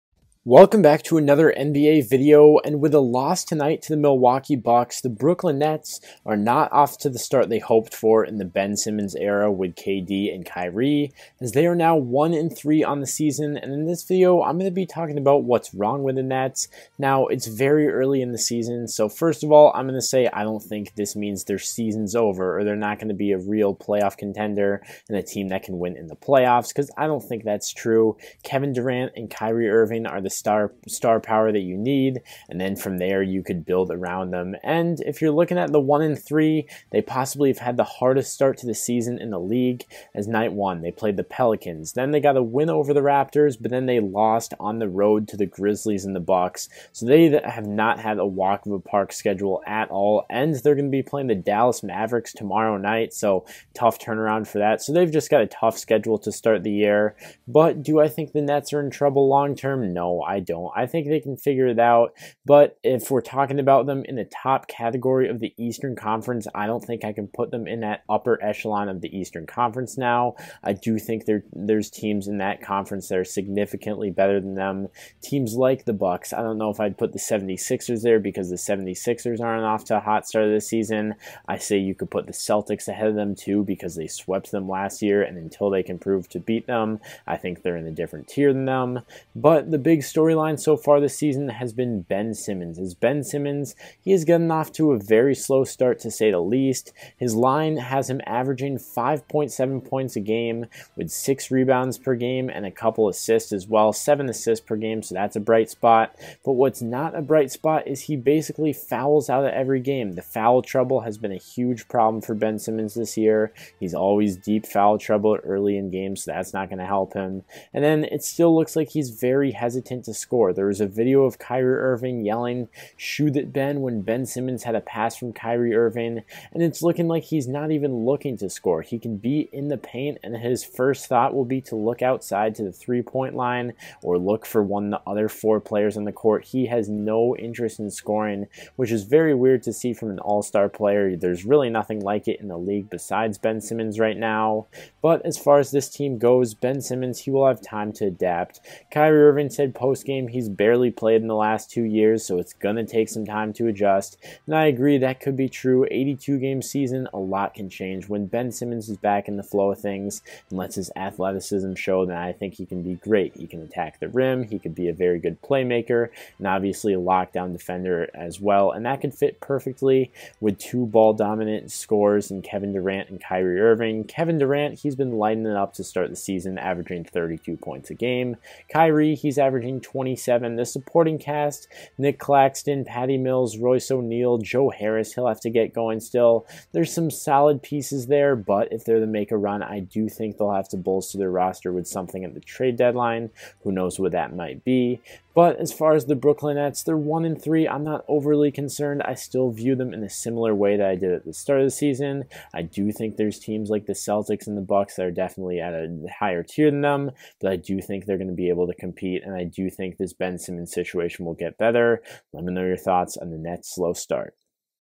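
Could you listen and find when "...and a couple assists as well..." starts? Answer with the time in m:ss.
1:42.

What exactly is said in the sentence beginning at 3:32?
Let me know your thoughts on the Nets' slow start.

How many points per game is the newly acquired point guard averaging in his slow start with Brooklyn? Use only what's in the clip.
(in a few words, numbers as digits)
5.7.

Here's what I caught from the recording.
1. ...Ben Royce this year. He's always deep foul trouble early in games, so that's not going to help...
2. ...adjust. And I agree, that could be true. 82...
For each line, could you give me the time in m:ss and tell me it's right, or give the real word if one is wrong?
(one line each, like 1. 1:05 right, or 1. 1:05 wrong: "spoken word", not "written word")
1. 1:52 wrong: "Simmons", not "Royce"
2. 2:33 right.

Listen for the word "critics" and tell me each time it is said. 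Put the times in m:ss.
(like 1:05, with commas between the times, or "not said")
not said.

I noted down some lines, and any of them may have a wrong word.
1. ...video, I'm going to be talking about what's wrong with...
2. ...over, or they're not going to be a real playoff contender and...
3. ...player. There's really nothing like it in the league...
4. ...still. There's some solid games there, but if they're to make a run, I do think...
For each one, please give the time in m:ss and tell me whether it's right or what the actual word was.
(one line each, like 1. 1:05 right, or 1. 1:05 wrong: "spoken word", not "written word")
1. 0:14 right
2. 0:22 right
3. 2:20 right
4. 3:05 wrong: "pieces", not "games".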